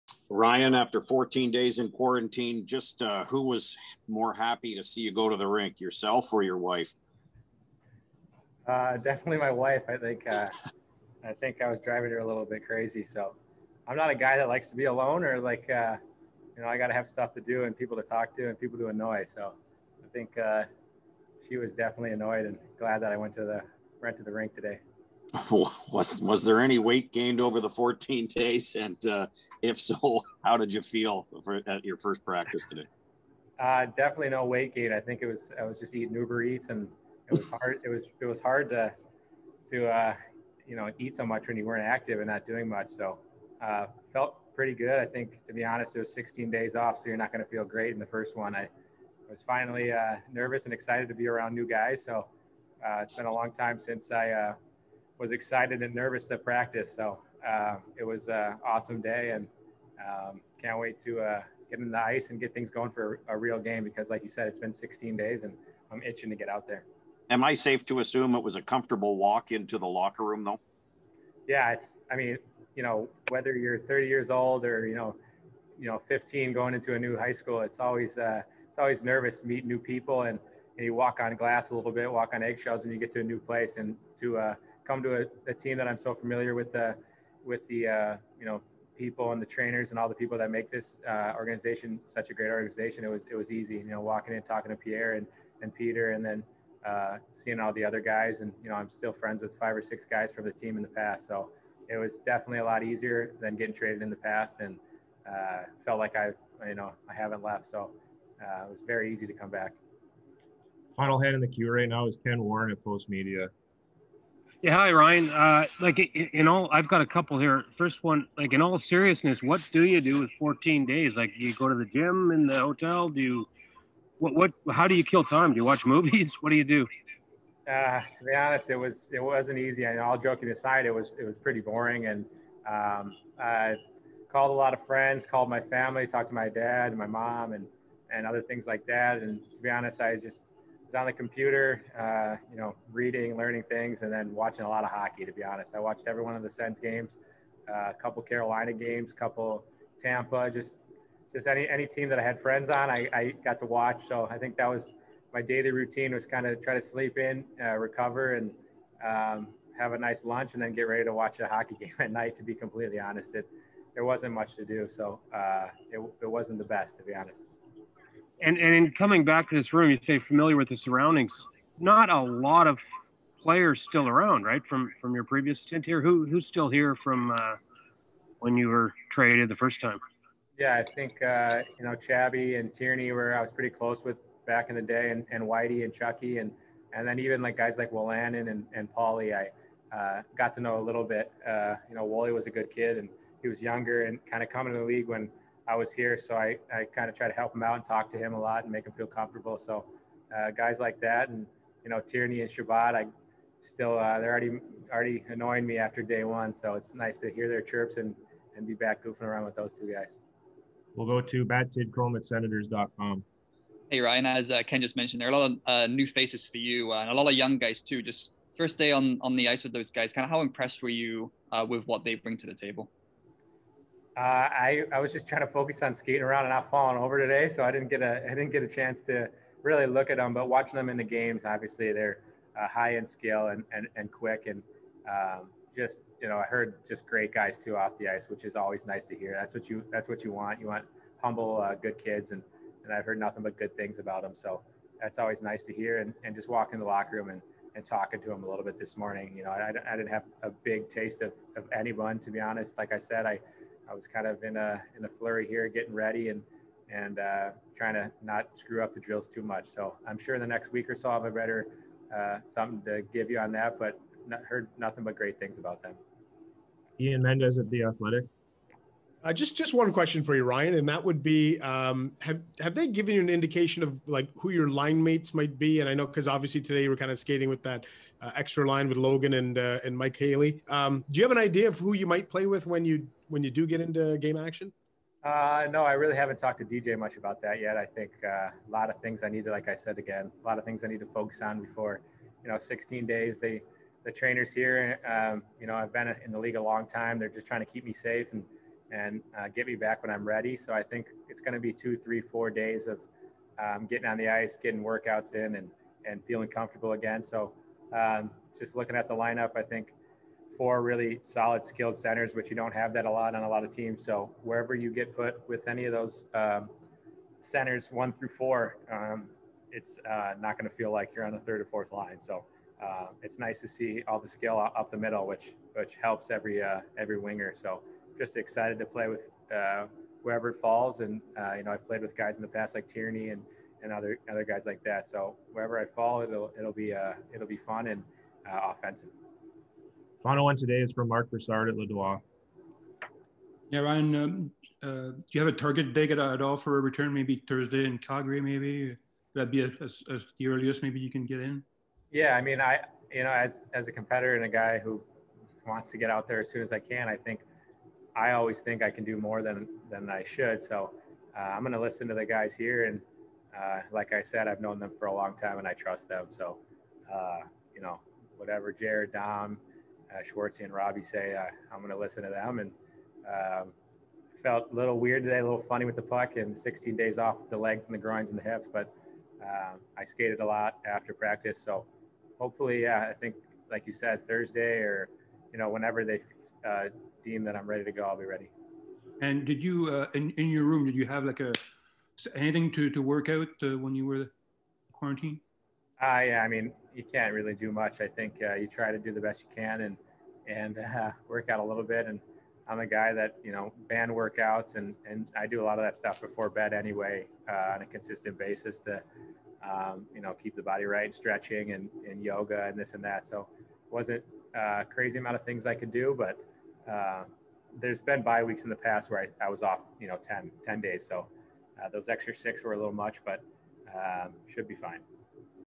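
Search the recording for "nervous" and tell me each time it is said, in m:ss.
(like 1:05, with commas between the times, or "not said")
0:50, 0:55, 1:19.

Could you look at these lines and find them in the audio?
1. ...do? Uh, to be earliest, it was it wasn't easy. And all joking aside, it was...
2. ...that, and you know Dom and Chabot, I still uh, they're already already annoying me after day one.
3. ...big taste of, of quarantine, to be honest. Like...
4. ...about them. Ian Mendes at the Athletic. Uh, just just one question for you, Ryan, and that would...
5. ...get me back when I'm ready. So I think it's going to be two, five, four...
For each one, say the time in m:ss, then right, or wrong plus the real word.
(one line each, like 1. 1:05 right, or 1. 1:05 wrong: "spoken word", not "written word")
1. 2:06 wrong: "honest", not "earliest"
2. 3:20 wrong: "Tierney", not "Dom"
3. 4:10 wrong: "anyone", not "quarantine"
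4. 4:25 right
5. 4:59 wrong: "three", not "five".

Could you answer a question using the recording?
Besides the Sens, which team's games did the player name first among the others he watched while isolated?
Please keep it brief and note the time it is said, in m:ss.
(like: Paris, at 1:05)
Carolina, at 2:28.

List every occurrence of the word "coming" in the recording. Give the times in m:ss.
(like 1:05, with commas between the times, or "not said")
2:48, 3:14.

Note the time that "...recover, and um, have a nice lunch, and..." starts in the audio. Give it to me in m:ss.
2:37.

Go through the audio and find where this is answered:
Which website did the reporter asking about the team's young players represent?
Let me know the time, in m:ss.
3:32.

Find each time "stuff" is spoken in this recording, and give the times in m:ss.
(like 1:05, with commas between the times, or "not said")
0:17, 6:45.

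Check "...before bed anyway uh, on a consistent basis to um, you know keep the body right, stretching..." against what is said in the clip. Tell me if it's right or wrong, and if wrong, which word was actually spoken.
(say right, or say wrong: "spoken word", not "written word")
right.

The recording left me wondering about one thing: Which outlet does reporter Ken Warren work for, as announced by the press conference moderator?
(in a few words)
Postmedia.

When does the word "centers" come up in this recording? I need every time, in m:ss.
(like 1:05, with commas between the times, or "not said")
5:11, 5:17.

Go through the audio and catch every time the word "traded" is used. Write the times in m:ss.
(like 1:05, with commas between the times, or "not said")
1:43, 2:59.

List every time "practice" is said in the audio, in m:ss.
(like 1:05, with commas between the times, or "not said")
0:32, 0:56, 6:21.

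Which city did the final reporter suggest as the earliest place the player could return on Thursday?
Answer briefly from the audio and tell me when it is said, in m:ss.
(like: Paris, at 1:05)
Calgary, at 5:47.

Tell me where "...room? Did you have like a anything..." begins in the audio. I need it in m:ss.
6:30.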